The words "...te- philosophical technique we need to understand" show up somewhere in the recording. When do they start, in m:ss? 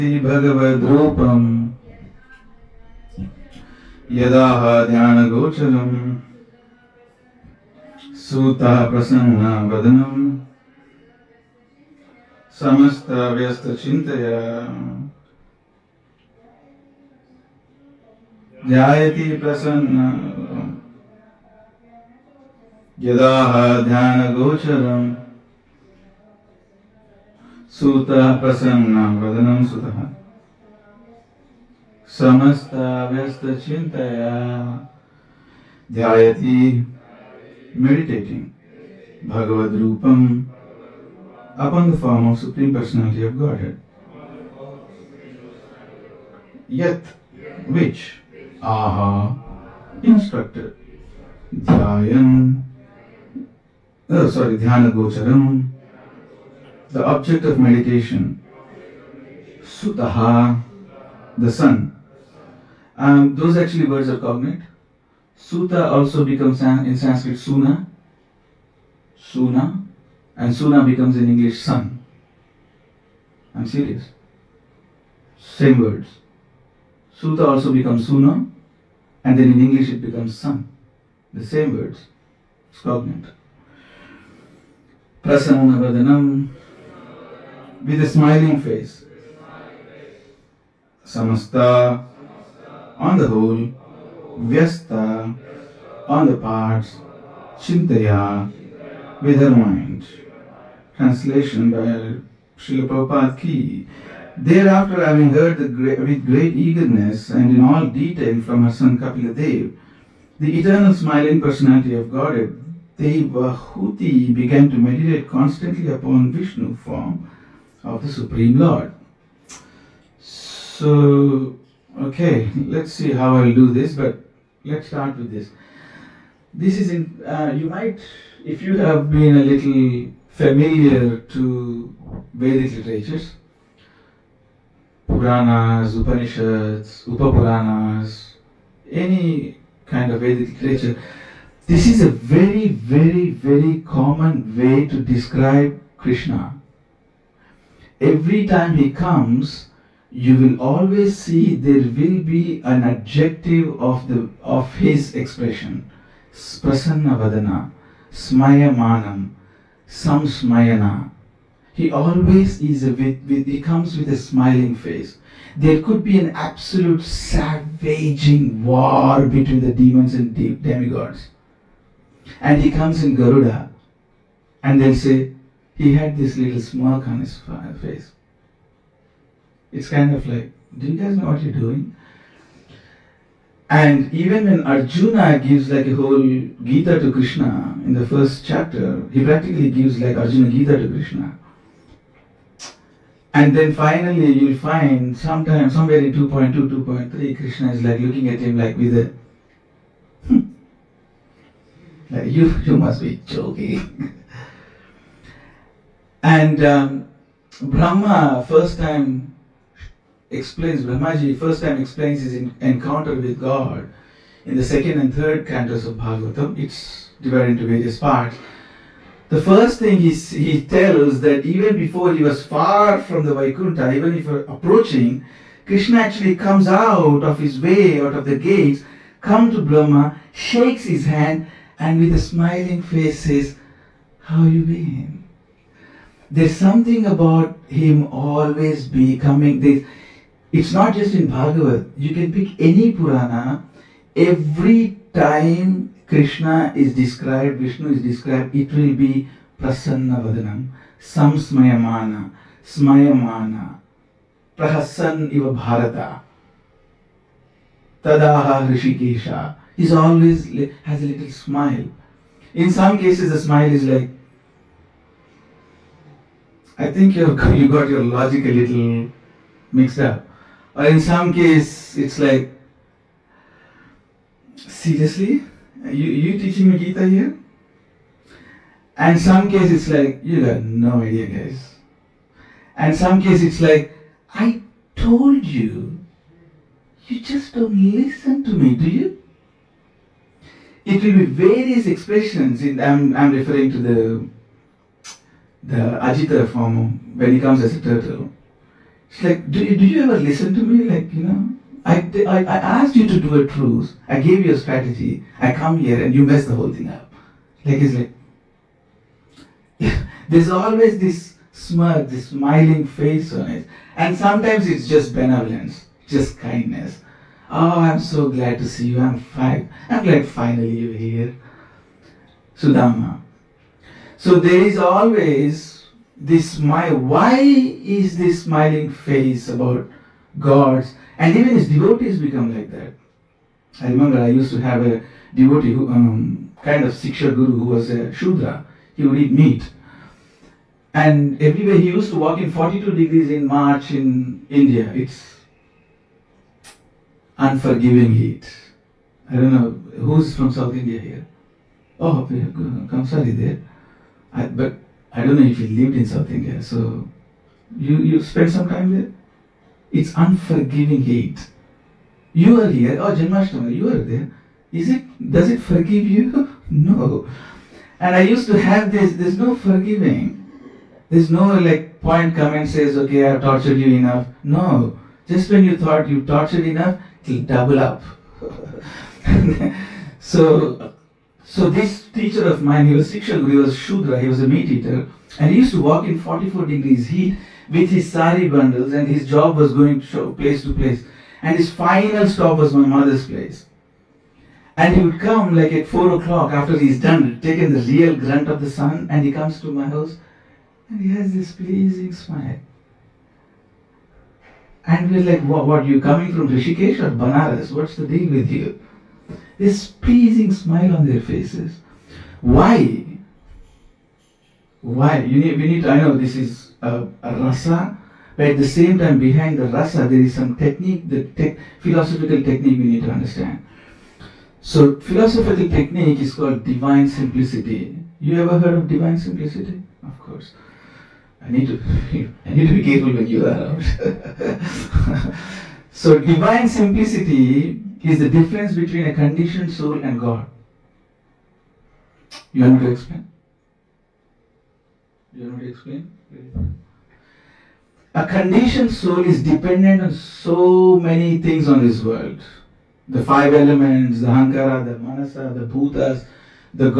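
7:01.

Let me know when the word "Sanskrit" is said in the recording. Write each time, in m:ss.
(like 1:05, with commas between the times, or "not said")
1:06.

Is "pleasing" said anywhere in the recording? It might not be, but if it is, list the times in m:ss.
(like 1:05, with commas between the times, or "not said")
6:41, 6:50.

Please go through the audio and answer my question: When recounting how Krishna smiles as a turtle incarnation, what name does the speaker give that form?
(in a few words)
Ajita.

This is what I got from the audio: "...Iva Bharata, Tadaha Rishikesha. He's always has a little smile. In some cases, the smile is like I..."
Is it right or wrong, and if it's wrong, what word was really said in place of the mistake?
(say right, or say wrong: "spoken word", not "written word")
right.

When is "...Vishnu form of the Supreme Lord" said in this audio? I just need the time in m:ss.
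1:56.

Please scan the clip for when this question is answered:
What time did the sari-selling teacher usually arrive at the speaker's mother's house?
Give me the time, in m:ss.
6:35.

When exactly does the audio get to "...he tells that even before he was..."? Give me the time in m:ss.
3:40.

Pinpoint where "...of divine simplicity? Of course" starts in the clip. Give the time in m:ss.
7:08.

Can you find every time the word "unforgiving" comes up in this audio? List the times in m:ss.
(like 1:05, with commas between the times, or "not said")
5:47, 6:00.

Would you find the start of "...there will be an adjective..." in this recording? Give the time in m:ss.
2:31.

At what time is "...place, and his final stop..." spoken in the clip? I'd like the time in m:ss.
6:30.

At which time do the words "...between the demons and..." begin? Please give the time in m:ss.
2:49.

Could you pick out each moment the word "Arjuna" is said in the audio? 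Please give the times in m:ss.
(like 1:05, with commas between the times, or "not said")
3:04, 3:10.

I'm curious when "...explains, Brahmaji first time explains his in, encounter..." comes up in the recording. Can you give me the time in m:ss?
3:30.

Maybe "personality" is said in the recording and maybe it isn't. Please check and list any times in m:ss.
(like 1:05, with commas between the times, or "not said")
0:42, 1:51.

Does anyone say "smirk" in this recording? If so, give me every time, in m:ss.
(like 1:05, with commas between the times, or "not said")
2:56, 5:11.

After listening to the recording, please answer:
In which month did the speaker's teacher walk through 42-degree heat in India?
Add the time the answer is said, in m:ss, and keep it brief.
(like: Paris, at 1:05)
March, at 5:43.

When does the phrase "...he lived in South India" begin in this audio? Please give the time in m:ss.
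5:55.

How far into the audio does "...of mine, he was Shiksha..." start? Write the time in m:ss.
6:22.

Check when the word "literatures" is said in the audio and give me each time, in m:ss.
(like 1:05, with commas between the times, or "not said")
2:12, 2:20.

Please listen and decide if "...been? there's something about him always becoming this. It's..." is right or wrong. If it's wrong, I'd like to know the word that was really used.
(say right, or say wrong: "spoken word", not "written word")
right.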